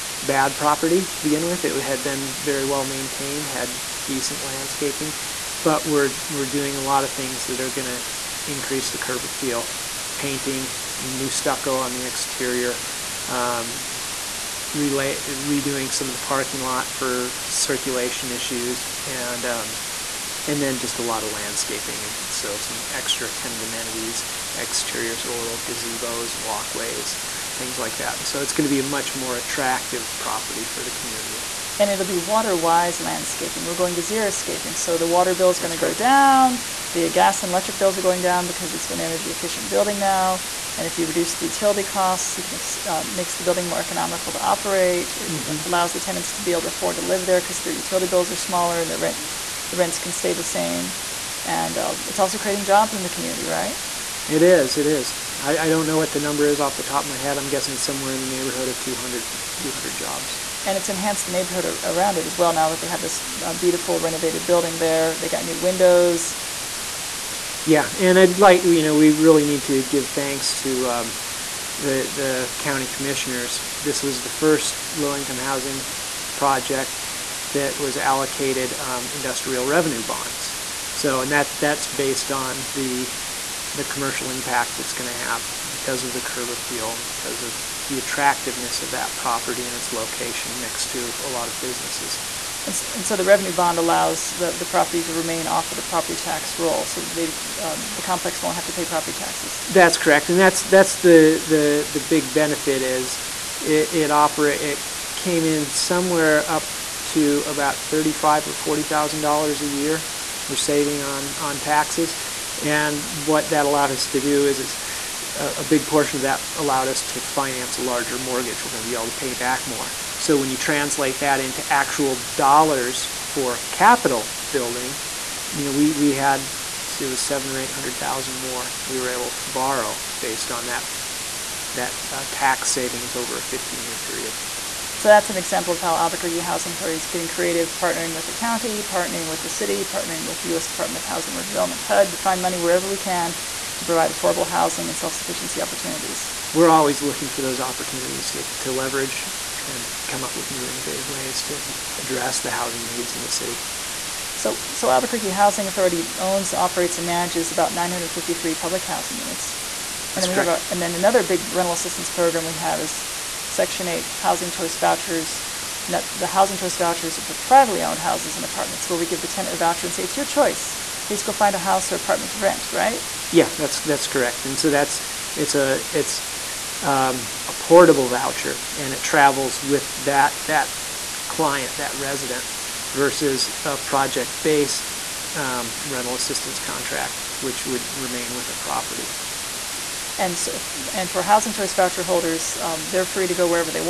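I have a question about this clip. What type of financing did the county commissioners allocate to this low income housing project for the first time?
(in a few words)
Industrial revenue bonds.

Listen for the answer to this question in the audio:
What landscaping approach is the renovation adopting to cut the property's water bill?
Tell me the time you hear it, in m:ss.
0:34.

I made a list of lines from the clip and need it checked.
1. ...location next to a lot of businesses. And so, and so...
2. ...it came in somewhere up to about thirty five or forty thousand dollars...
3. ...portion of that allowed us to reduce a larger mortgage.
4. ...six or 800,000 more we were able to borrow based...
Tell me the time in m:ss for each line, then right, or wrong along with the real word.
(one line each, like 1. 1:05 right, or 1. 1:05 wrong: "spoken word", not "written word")
1. 1:29 right
2. 1:44 right
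3. 1:55 wrong: "finance", not "reduce"
4. 2:07 wrong: "seven", not "six".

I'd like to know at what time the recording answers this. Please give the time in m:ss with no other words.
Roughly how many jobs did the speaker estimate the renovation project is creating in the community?
0:59.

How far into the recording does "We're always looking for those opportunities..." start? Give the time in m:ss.
2:26.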